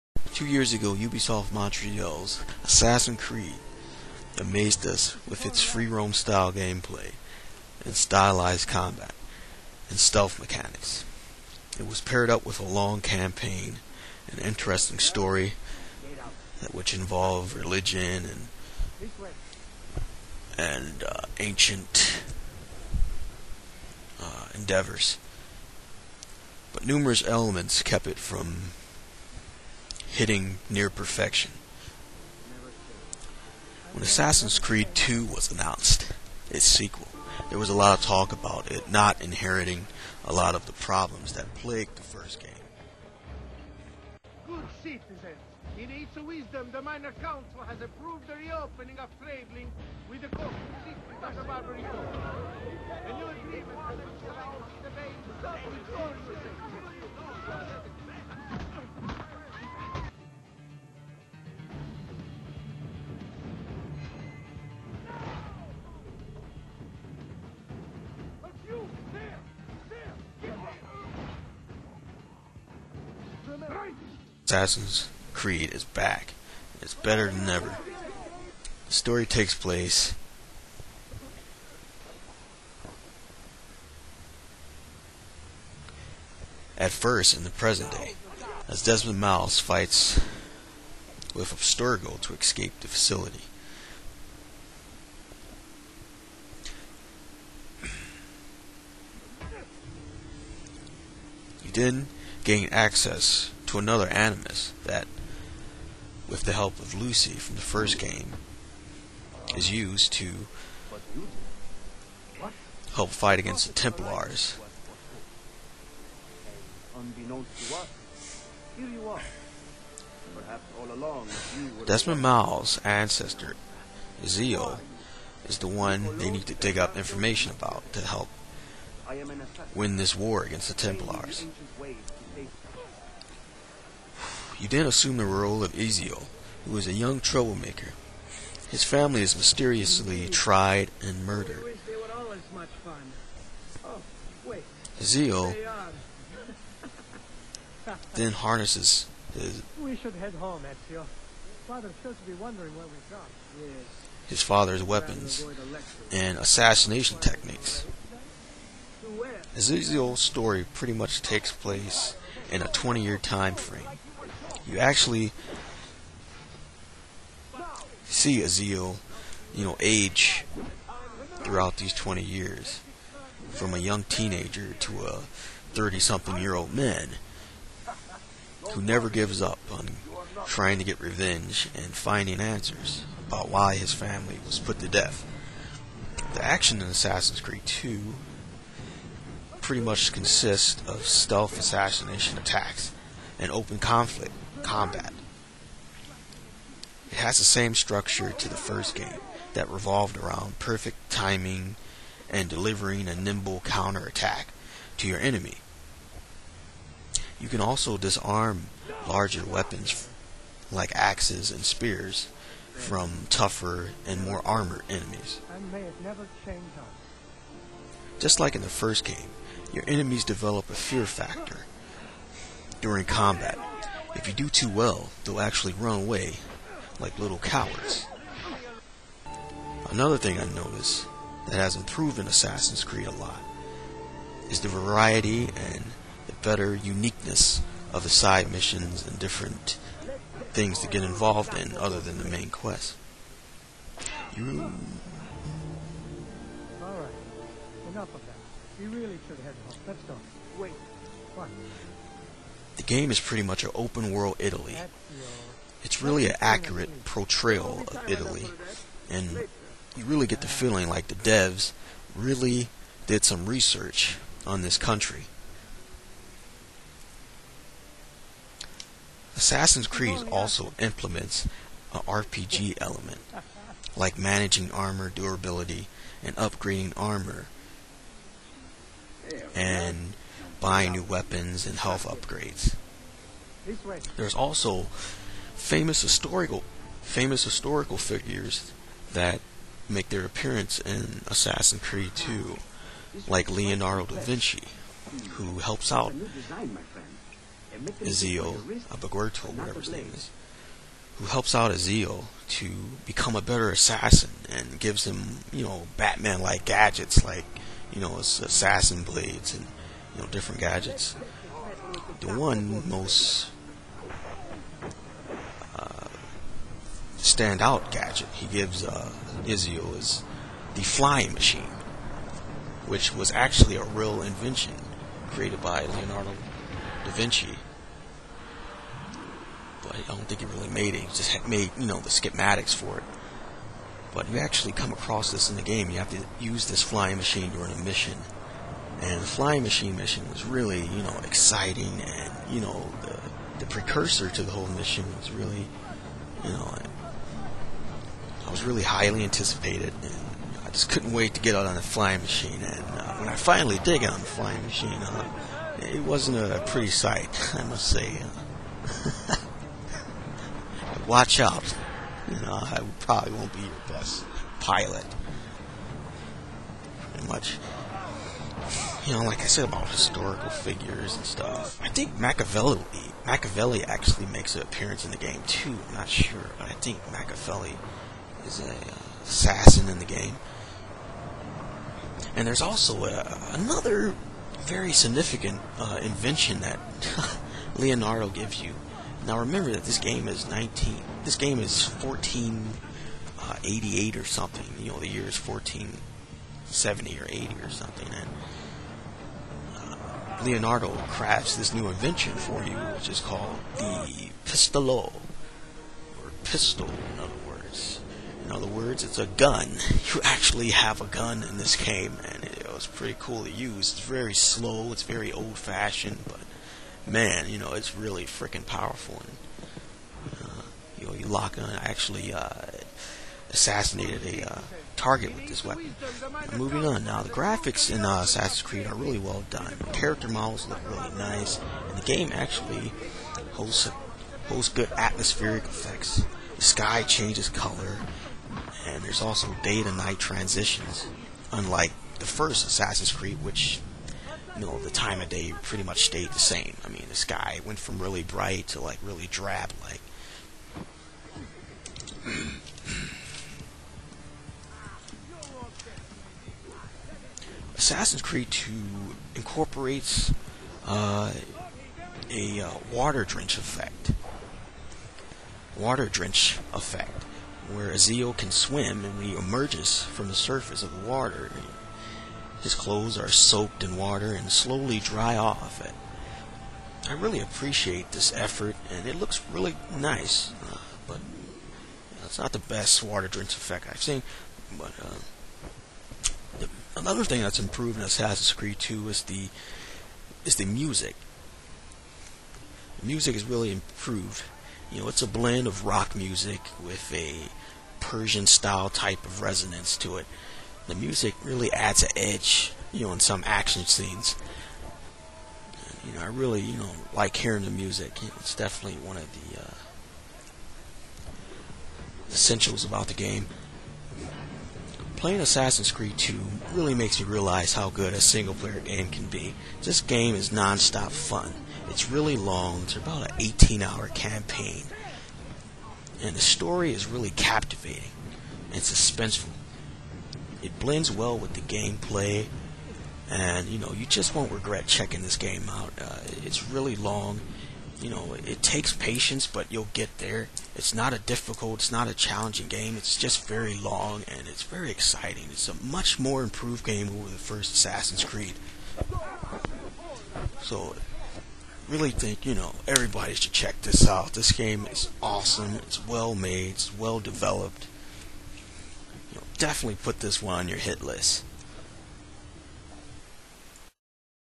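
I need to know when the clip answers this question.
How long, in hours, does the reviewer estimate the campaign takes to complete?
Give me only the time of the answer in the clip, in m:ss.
8:43.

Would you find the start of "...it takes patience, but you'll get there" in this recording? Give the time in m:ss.
8:58.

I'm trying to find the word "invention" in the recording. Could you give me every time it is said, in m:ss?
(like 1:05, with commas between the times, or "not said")
5:24, 6:26, 6:41.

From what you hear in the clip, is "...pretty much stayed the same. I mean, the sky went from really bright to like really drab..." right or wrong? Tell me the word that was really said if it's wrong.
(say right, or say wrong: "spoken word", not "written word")
right.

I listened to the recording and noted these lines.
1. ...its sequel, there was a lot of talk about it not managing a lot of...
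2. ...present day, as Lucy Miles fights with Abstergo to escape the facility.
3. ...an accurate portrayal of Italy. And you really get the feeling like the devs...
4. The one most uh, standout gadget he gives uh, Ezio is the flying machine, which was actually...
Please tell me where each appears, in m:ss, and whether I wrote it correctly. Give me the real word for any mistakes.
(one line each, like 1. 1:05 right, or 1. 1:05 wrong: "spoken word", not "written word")
1. 0:36 wrong: "inheriting", not "managing"
2. 1:27 wrong: "Desmond", not "Lucy"
3. 4:16 right
4. 5:12 right.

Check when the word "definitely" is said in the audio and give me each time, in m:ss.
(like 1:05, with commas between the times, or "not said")
8:28, 9:19.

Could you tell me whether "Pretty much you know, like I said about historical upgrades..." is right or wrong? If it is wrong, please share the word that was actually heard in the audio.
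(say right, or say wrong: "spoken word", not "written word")
wrong: "figures", not "upgrades".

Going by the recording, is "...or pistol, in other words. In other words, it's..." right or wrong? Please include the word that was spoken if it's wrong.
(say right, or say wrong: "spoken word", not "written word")
right.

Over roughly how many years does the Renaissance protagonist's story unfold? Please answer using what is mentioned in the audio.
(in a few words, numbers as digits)
20.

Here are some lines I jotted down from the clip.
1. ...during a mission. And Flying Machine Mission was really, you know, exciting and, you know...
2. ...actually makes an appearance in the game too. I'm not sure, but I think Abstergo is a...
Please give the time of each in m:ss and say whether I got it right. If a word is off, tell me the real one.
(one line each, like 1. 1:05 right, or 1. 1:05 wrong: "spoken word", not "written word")
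1. 5:37 right
2. 6:13 wrong: "Machiavelli", not "Abstergo".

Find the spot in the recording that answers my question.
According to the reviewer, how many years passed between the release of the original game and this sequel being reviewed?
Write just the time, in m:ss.
0:00.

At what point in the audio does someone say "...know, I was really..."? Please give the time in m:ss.
5:46.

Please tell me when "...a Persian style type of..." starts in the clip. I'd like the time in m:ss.
8:17.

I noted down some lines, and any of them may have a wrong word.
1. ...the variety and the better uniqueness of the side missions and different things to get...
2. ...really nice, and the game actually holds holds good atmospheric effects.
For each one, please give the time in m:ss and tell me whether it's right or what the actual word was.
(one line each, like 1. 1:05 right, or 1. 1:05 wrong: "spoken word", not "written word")
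1. 3:54 right
2. 7:10 right.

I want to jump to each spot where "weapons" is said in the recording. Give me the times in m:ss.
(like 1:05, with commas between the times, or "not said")
2:34, 3:29, 4:41, 7:05.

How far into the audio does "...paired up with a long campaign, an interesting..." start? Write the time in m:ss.
0:12.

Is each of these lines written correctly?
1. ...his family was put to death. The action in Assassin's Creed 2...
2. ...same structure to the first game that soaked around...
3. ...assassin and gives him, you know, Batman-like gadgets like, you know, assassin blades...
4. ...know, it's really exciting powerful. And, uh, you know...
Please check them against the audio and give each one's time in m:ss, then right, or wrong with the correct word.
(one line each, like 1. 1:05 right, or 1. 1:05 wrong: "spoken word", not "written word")
1. 3:03 right
2. 3:17 wrong: "revolved", not "soaked"
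3. 5:03 right
4. 6:57 wrong: "freaking", not "exciting".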